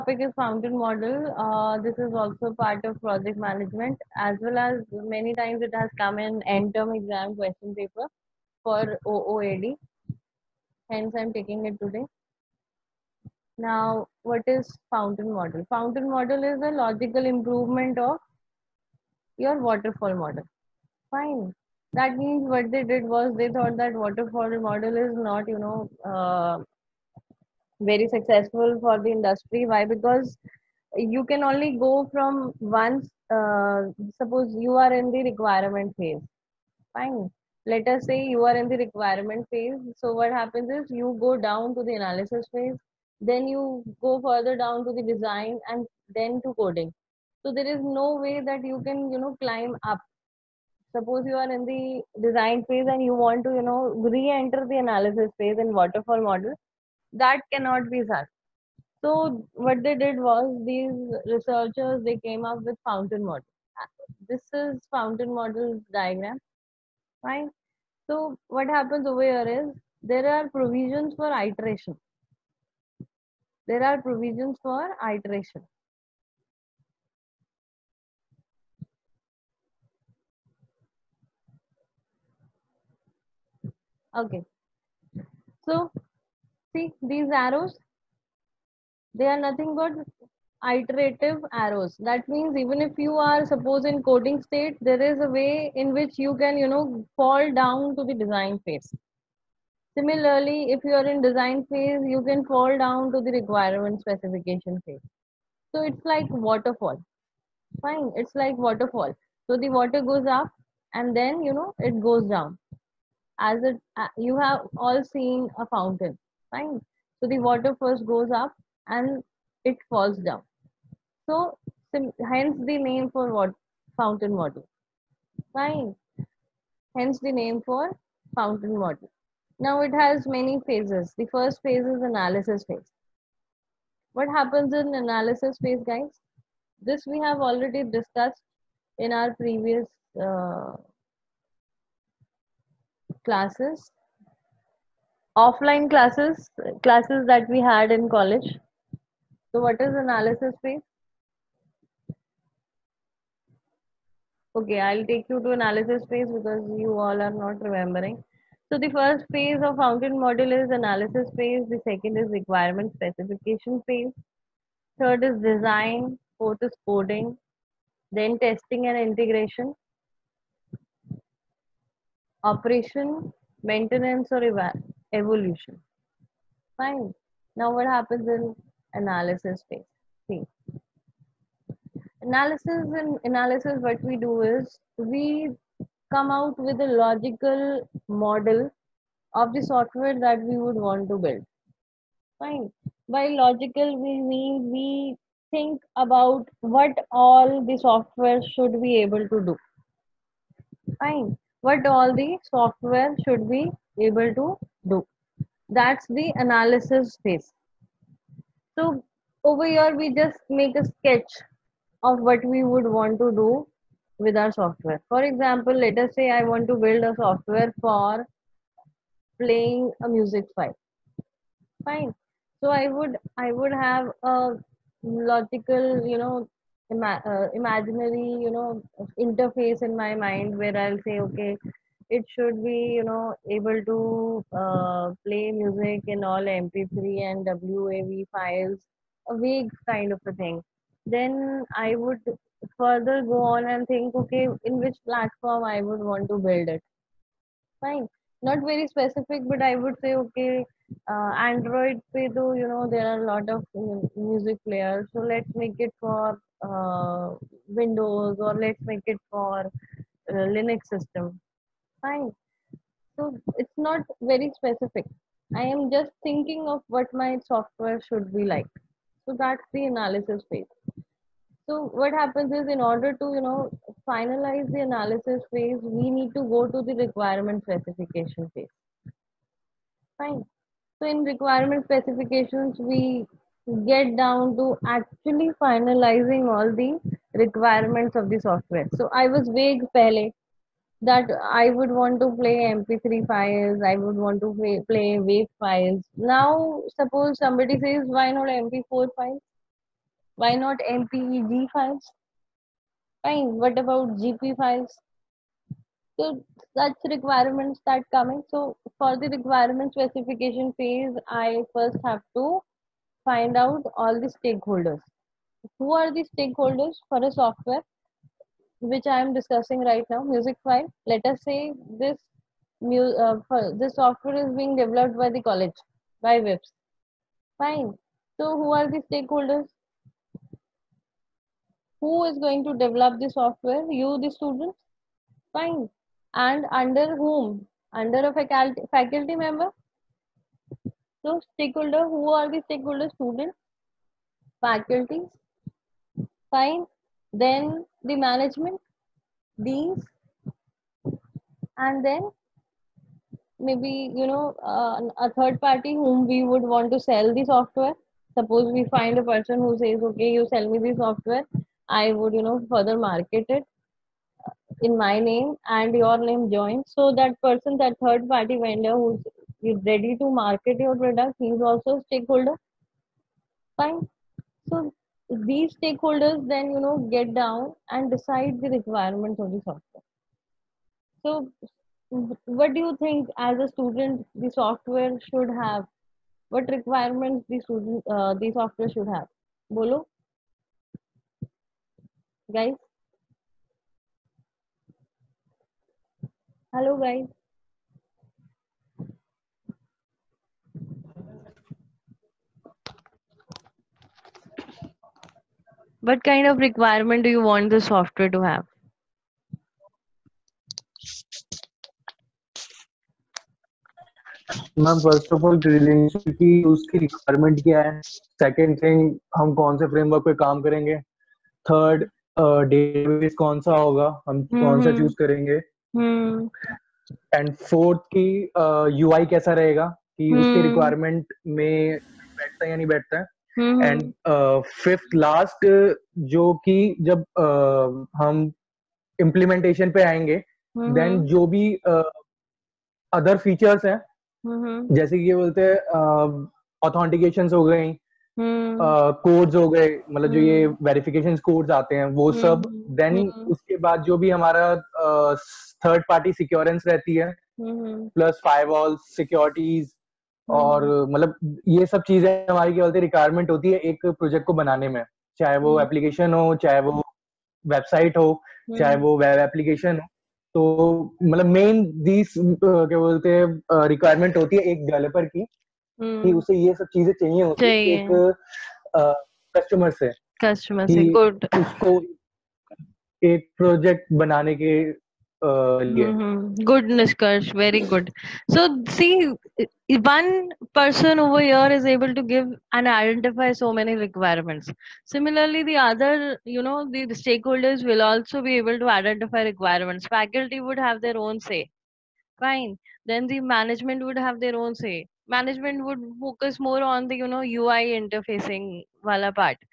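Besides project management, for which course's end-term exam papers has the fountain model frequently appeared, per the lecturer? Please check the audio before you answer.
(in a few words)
OOAD.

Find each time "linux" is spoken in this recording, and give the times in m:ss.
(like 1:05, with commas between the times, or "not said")
4:20.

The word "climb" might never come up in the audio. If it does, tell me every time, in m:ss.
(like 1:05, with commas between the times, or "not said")
0:49.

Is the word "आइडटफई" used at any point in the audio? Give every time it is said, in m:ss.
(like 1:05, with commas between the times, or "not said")
8:12, 8:18.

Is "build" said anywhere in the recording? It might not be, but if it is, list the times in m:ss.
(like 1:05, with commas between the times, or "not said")
3:11, 3:36, 4:06.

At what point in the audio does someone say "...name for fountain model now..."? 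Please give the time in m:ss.
2:07.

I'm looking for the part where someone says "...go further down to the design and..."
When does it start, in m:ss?
0:44.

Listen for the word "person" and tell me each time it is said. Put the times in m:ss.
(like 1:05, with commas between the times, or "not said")
5:59, 6:07.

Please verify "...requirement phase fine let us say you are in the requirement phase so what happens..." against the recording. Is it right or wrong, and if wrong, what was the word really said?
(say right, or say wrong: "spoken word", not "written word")
right.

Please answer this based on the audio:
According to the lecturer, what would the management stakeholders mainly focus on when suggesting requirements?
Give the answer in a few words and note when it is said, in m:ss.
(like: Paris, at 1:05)
UI interfacing, at 8:27.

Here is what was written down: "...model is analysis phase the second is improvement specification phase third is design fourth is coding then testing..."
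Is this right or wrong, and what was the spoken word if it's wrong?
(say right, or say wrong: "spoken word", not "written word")
wrong: "requirement", not "improvement".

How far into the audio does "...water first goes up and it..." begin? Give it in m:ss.
1:57.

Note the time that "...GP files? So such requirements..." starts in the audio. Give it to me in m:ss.
5:04.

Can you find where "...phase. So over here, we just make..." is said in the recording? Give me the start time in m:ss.
3:27.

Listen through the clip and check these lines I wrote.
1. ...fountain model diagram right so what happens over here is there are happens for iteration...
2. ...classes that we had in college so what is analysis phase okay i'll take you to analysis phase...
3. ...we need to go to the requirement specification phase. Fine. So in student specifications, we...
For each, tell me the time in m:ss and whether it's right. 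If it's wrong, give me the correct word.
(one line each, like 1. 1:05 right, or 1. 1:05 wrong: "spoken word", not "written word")
1. 1:04 wrong: "provisions", not "happens"
2. 2:26 right
3. 4:35 wrong: "requirement", not "student".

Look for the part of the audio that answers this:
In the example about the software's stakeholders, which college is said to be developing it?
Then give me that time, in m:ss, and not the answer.
5:26.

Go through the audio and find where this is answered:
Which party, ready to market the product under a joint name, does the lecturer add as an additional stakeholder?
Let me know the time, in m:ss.
6:08.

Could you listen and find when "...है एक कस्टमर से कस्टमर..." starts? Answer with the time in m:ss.
7:57.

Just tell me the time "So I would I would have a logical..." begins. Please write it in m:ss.
3:42.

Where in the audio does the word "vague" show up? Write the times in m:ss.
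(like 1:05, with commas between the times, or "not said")
3:59, 4:49.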